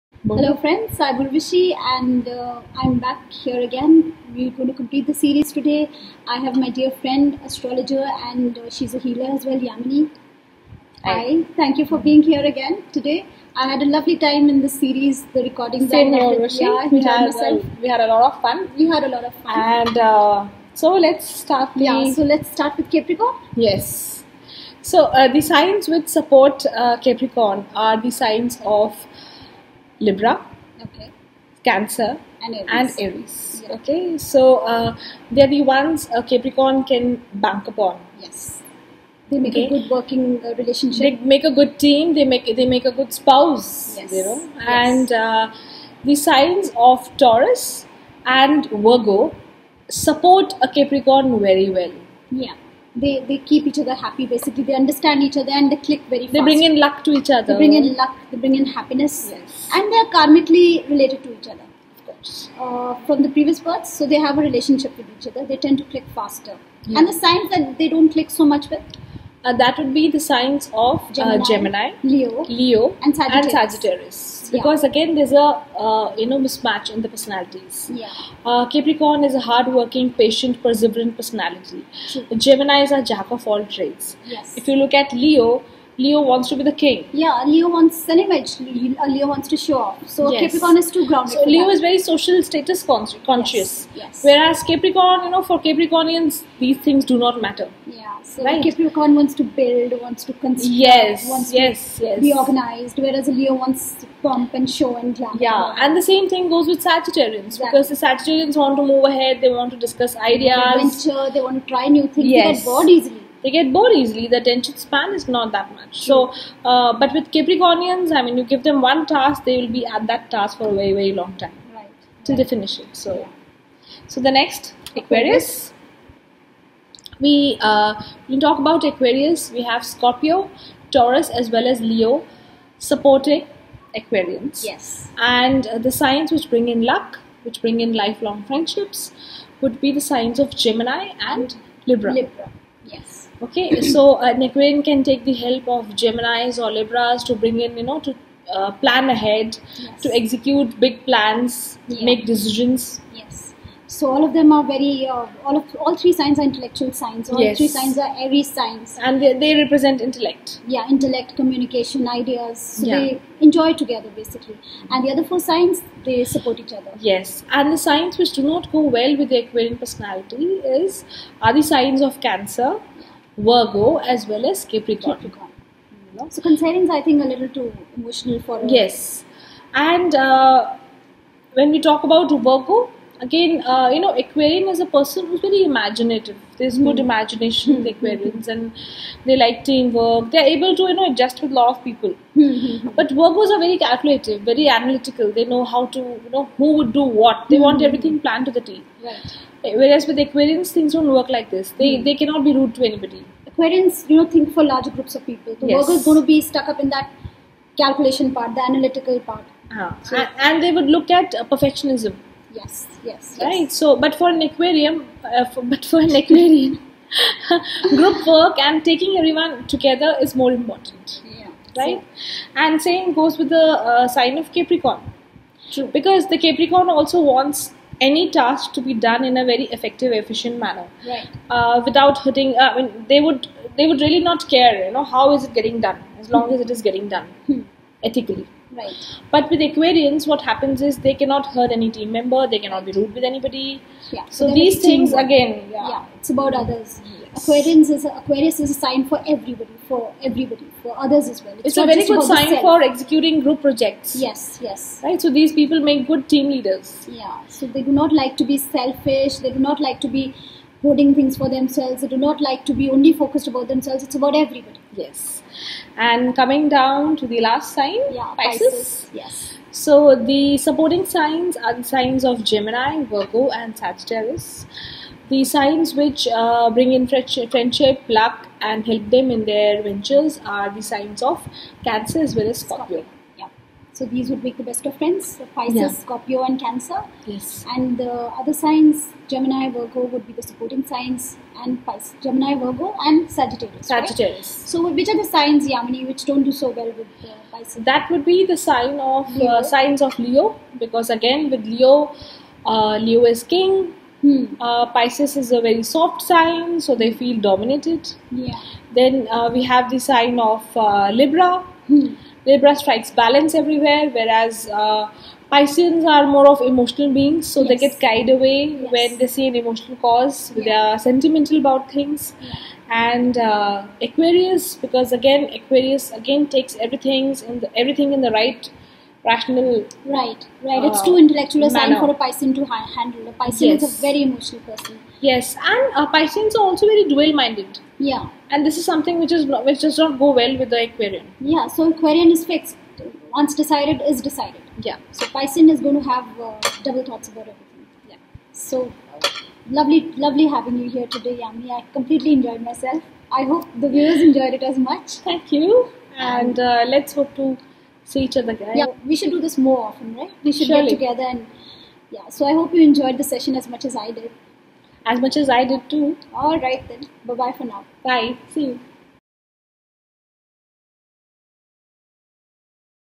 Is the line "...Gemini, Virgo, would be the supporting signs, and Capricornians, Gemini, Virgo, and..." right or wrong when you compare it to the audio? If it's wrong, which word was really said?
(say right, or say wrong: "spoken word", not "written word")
wrong: "Pisces", not "Capricornians".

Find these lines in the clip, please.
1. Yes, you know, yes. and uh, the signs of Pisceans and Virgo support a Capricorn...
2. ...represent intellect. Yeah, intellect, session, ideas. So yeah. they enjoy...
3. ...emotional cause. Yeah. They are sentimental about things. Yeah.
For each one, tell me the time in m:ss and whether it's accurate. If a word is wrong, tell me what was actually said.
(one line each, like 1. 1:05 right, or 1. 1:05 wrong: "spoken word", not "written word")
1. 0:43 wrong: "Taurus", not "Pisceans"
2. 2:39 wrong: "communication", not "session"
3. 5:19 right.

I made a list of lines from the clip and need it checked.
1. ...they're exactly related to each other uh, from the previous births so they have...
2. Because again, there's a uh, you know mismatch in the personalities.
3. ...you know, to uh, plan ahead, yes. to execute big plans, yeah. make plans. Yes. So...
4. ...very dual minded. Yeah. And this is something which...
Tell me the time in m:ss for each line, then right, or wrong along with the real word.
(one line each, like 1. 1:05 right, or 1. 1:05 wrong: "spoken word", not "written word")
1. 0:59 wrong: "karmically", not "exactly"
2. 1:14 right
3. 2:27 wrong: "decisions", not "plans"
4. 5:36 right.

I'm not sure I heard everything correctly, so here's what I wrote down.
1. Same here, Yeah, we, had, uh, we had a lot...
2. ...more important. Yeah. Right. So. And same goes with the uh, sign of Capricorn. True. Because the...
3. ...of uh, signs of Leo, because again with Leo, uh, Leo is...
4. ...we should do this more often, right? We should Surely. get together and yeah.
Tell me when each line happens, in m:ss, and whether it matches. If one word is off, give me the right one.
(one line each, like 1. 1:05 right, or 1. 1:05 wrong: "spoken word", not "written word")
1. 0:15 right
2. 3:40 right
3. 4:58 right
4. 5:59 right.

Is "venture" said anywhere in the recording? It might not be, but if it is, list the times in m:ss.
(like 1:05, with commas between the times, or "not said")
1:51, 4:39.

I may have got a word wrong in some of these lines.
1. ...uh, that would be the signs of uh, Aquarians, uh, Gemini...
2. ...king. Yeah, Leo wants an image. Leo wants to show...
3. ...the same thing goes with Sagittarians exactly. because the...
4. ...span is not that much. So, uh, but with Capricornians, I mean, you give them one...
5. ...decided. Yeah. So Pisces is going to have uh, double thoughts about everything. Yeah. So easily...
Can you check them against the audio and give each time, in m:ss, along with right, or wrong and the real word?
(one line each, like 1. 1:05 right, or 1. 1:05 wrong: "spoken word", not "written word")
1. 1:09 wrong: "Gemini", not "Aquarians"
2. 1:26 right
3. 1:45 right
4. 1:54 right
5. 5:44 wrong: "lovely", not "easily".